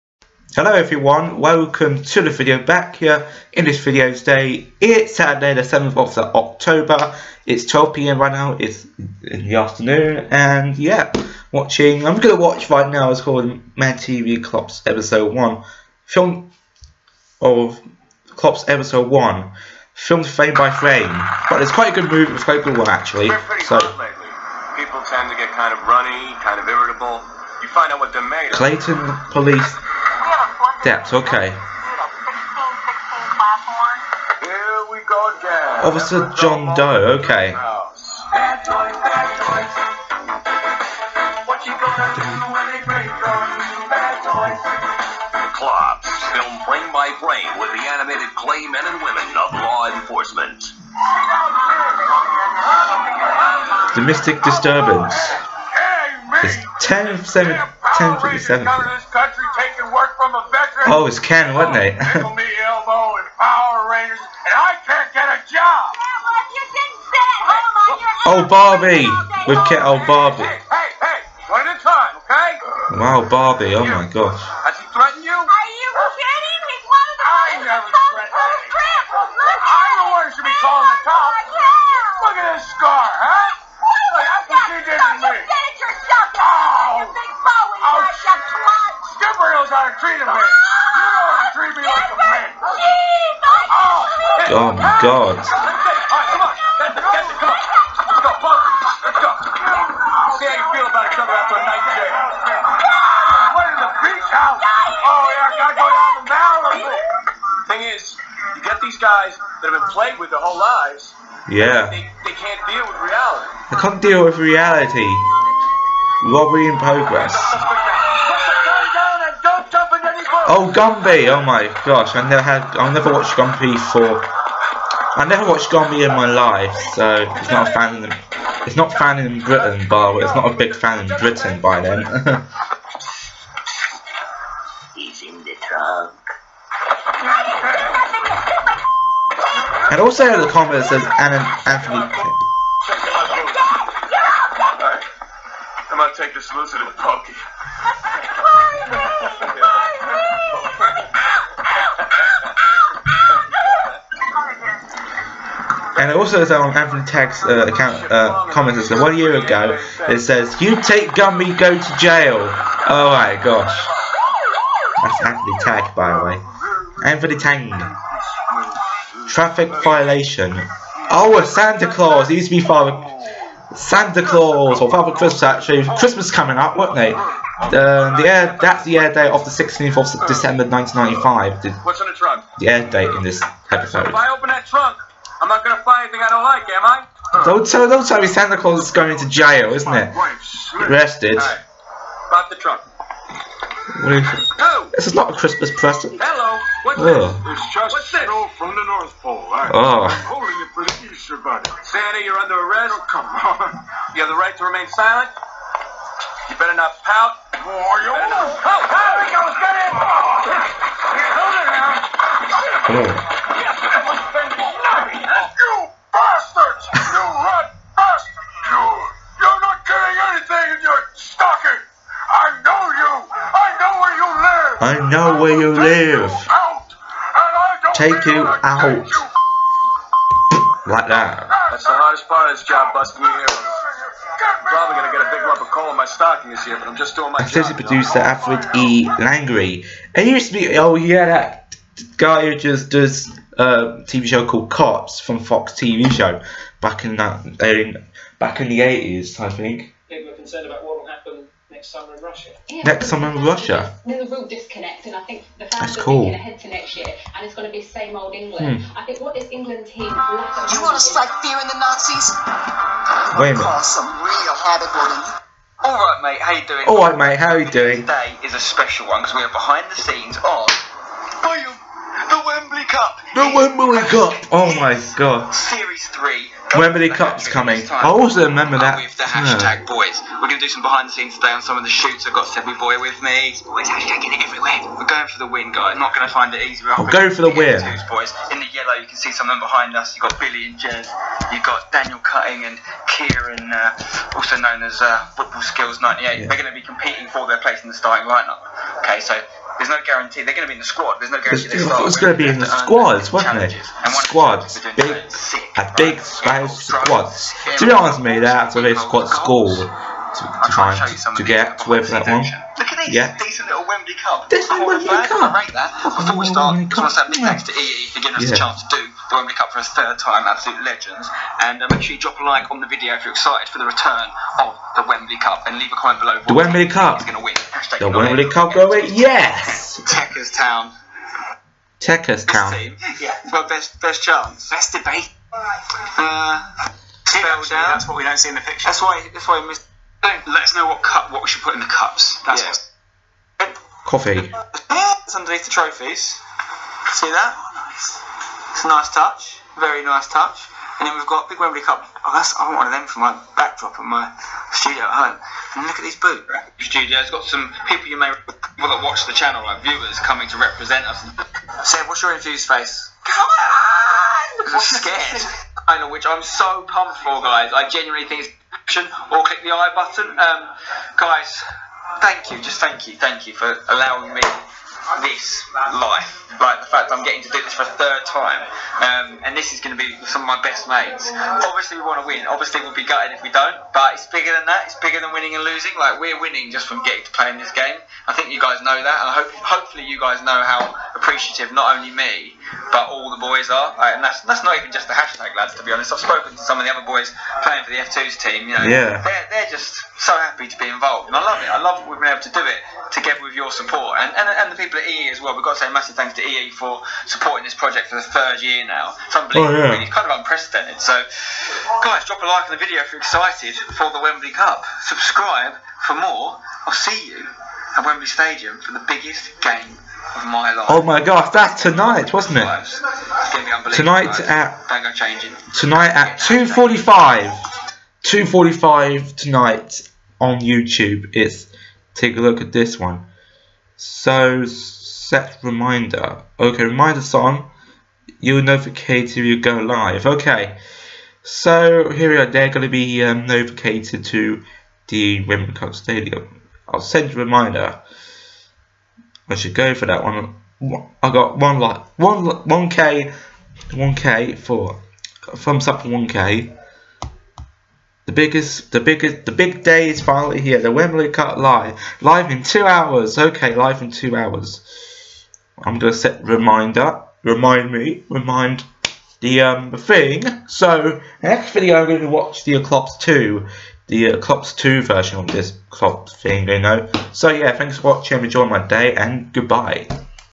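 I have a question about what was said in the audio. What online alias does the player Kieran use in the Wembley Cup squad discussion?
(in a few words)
Football Skills 98.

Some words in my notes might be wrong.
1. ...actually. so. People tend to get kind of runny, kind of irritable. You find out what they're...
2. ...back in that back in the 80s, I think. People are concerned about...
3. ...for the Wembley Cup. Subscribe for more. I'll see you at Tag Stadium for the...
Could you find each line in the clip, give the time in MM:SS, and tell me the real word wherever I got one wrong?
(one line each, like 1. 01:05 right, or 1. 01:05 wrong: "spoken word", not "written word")
1. 00:22 right
2. 04:06 right
3. 06:53 wrong: "Wembley", not "Tag".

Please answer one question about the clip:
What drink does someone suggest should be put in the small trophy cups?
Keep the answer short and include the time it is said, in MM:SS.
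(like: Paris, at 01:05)
Coffee, at 05:44.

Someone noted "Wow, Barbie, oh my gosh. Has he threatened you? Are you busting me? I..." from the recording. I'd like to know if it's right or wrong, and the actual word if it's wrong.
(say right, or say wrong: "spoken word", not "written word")
wrong: "kidding", not "busting".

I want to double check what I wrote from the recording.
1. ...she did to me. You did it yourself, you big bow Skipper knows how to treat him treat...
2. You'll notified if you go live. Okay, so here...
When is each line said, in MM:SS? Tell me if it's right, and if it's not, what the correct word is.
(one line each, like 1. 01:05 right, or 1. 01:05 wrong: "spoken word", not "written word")
1. 01:24 right
2. 07:18 right.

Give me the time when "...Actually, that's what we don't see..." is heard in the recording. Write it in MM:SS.
05:37.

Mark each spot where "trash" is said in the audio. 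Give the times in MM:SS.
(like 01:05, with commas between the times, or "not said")
not said.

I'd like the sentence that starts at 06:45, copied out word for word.
We've got to say massive thanks to EE for supporting this project for the third year now.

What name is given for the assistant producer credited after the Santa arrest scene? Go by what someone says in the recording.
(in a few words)
Alfred E. Langry.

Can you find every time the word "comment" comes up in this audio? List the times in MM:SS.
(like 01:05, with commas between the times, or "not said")
02:20, 02:38, 05:25.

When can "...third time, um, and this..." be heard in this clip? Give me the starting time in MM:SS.
06:17.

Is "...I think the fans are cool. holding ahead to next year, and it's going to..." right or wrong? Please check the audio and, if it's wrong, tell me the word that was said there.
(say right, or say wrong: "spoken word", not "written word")
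wrong: "thinking", not "holding".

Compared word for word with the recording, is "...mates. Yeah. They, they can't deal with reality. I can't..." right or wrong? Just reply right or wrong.
wrong.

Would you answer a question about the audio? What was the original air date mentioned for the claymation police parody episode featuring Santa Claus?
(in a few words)
16 December 1995.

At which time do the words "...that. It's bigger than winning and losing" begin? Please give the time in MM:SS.
06:24.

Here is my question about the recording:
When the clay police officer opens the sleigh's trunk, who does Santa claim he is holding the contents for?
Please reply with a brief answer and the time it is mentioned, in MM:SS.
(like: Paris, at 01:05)
The Easter Bunny, at 03:21.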